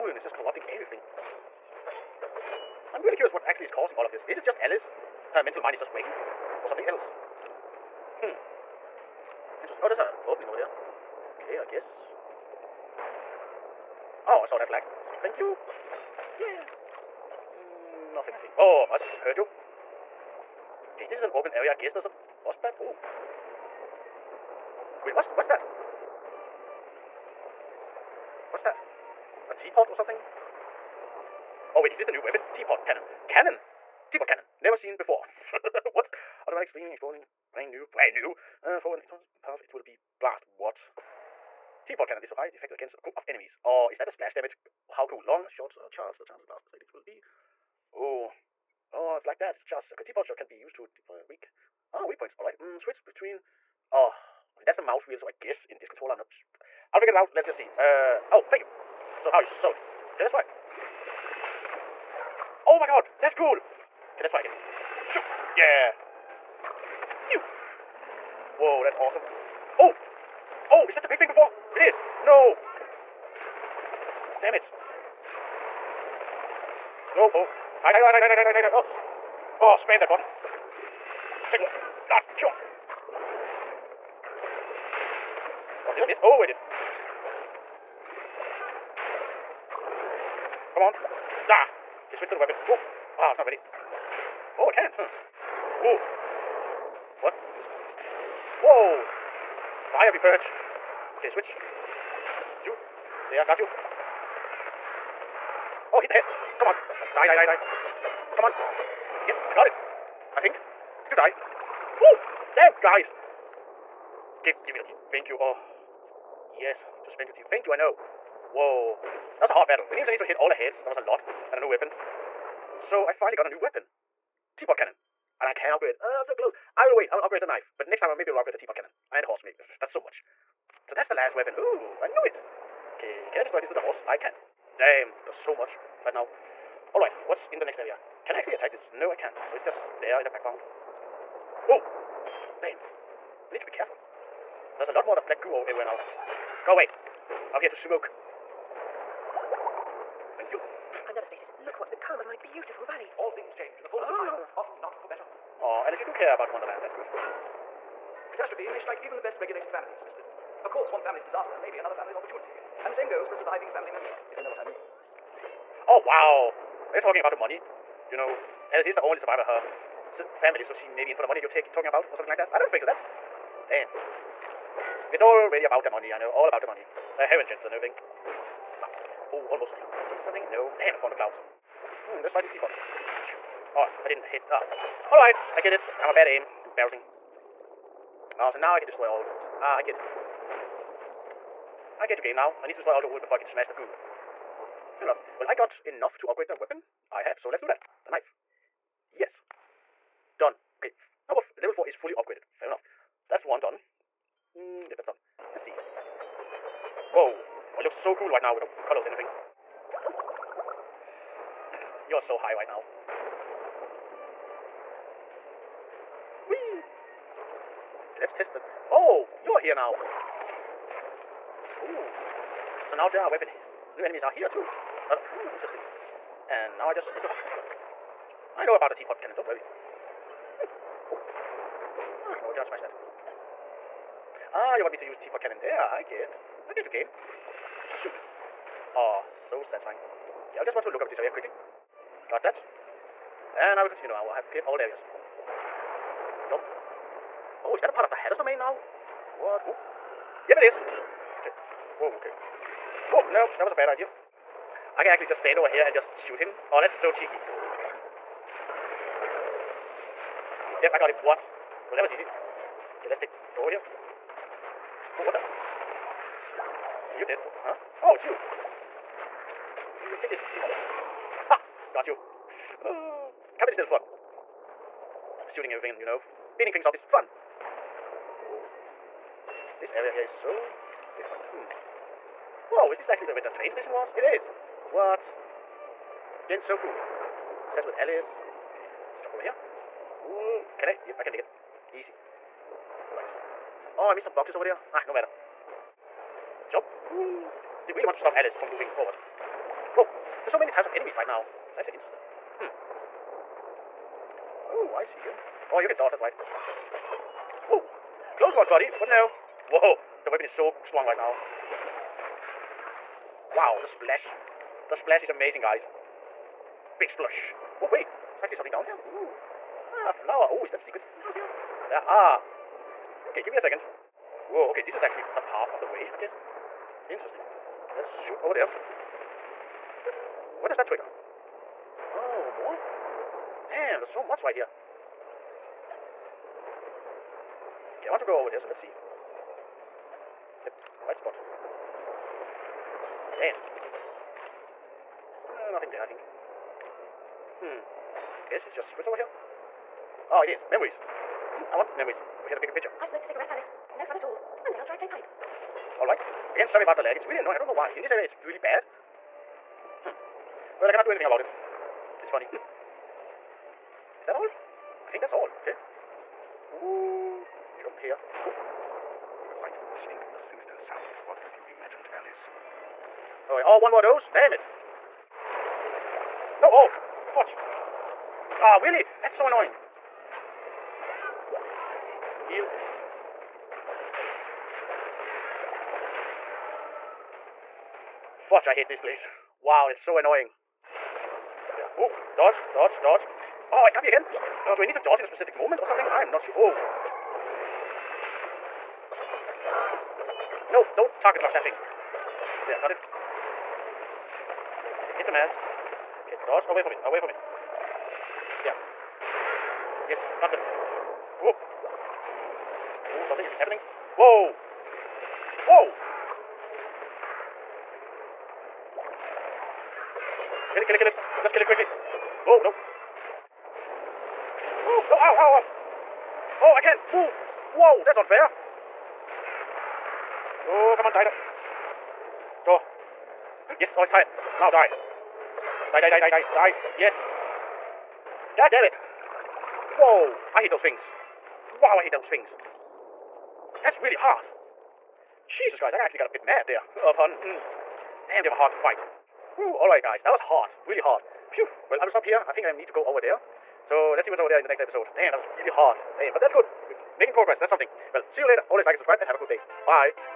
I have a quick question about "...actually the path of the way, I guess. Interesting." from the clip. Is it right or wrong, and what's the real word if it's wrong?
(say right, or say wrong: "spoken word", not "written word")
right.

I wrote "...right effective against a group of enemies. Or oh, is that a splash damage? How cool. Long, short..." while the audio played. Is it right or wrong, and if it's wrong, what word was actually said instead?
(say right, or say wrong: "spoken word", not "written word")
right.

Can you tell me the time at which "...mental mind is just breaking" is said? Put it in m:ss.
0:05.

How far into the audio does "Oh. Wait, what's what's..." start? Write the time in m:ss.
0:22.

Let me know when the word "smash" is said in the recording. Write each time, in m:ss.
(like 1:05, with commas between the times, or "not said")
3:13, 3:52.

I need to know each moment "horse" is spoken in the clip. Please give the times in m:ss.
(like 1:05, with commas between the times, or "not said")
2:09, 2:13.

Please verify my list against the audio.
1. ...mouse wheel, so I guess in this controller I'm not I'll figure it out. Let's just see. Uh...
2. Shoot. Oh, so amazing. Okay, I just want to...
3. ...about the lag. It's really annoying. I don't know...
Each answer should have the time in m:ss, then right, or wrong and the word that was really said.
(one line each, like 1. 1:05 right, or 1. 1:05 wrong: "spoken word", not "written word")
1. 0:54 right
2. 3:57 wrong: "satisfying", not "amazing"
3. 5:56 right.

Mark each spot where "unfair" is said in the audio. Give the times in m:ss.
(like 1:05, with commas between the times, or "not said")
7:08.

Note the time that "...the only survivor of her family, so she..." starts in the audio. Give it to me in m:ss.
2:48.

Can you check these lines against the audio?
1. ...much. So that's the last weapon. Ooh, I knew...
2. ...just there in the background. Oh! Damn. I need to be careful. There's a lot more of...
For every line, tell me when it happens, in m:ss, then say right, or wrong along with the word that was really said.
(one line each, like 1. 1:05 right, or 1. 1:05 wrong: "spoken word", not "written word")
1. 2:09 right
2. 2:19 right.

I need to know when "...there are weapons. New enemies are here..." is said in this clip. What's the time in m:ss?
3:43.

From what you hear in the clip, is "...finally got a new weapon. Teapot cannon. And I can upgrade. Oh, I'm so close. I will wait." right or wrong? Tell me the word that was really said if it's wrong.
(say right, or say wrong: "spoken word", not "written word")
right.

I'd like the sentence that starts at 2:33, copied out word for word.
All things change in the fullness of time, ah.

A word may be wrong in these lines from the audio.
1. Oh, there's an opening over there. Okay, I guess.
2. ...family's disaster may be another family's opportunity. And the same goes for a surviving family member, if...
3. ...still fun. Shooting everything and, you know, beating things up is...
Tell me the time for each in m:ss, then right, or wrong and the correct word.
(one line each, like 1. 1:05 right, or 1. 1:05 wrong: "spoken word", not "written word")
1. 0:09 right
2. 2:41 right
3. 4:33 right.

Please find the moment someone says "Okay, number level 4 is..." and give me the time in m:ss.
3:20.